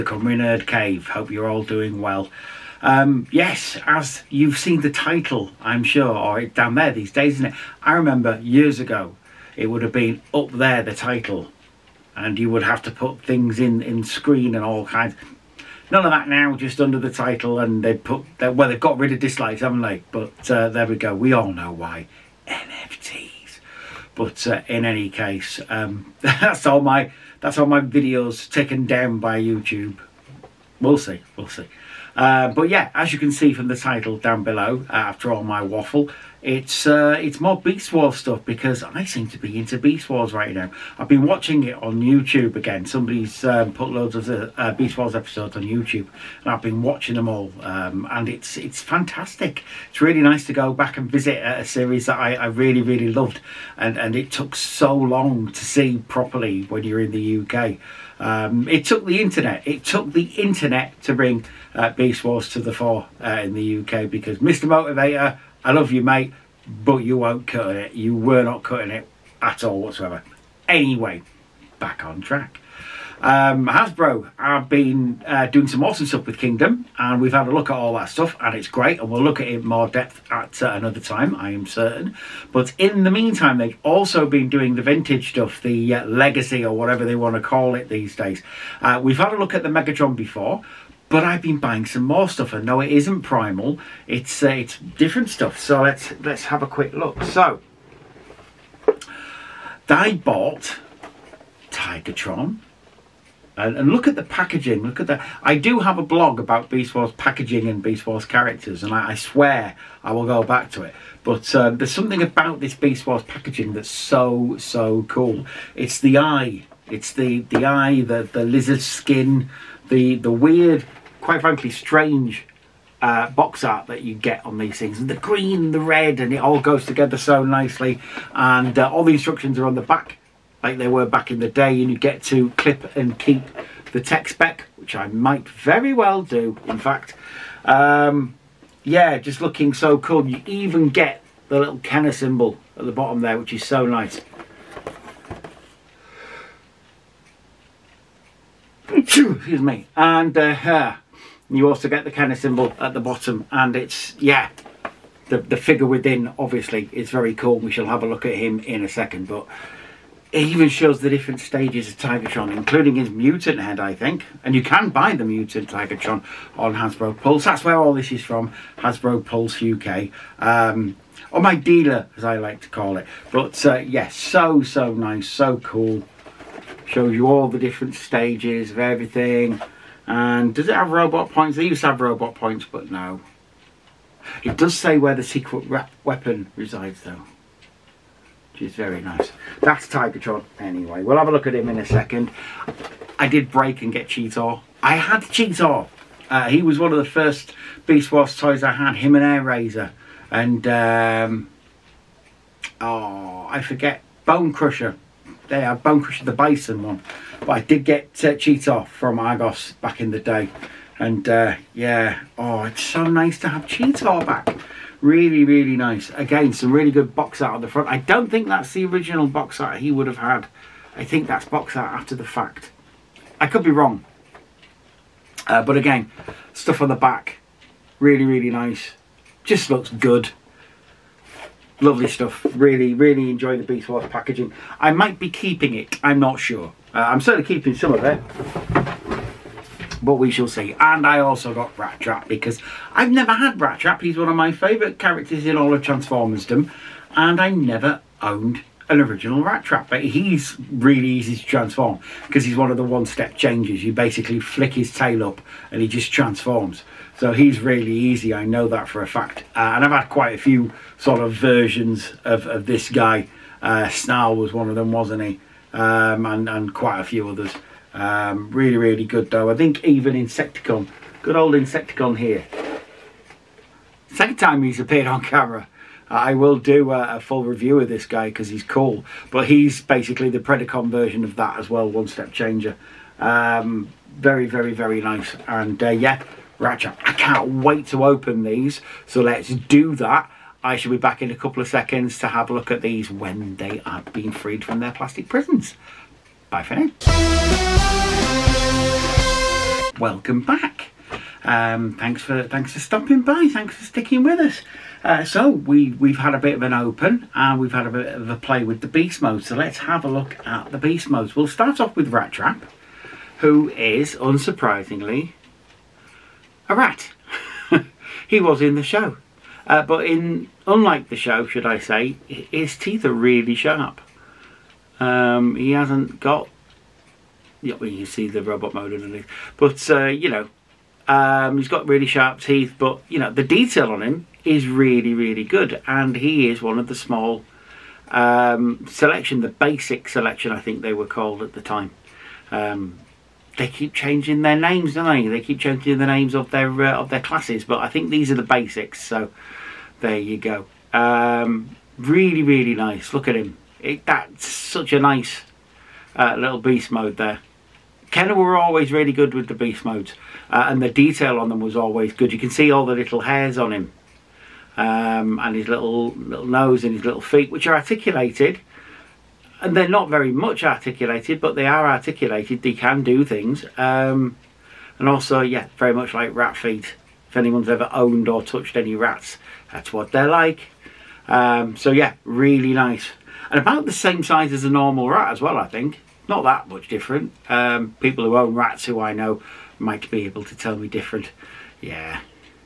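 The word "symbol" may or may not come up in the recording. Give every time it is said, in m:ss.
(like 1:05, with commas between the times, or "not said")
2:22, 2:32.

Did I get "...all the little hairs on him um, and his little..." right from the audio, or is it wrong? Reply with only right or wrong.
right.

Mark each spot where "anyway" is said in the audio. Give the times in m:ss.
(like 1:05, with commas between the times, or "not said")
1:10, 3:10.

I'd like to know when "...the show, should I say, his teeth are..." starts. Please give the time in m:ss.
5:21.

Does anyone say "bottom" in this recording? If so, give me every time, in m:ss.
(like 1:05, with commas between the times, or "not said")
2:22, 2:32.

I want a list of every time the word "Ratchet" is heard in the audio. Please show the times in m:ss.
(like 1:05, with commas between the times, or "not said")
4:46.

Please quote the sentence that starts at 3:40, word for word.
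I think that's box art after the fact.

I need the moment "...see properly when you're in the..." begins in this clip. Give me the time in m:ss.
0:55.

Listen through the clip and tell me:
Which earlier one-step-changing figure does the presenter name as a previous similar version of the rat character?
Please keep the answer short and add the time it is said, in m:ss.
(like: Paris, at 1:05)
Snarl, at 4:23.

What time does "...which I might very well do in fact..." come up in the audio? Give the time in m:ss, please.
2:14.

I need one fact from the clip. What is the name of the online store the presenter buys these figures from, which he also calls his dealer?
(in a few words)
Hasbro Pulse UK.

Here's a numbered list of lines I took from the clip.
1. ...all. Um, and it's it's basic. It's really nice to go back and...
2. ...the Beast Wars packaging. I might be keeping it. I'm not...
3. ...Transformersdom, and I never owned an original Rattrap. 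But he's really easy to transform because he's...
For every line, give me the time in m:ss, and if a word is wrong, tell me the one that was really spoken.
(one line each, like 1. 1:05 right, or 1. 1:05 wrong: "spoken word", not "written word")
1. 0:47 wrong: "fantastic", not "basic"
2. 3:53 right
3. 4:05 right.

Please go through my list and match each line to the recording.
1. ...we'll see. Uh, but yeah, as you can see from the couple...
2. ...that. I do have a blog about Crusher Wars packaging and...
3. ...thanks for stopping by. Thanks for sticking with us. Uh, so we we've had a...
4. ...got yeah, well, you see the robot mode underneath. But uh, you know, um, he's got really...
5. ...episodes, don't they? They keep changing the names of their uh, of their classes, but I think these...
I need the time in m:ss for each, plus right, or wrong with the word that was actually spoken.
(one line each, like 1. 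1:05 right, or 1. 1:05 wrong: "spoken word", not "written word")
1. 0:31 wrong: "title", not "couple"
2. 1:45 wrong: "Beast", not "Crusher"
3. 5:02 right
4. 5:26 right
5. 5:44 wrong: "names", not "episodes".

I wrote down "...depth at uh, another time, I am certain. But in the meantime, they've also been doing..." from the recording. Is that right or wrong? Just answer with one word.
right.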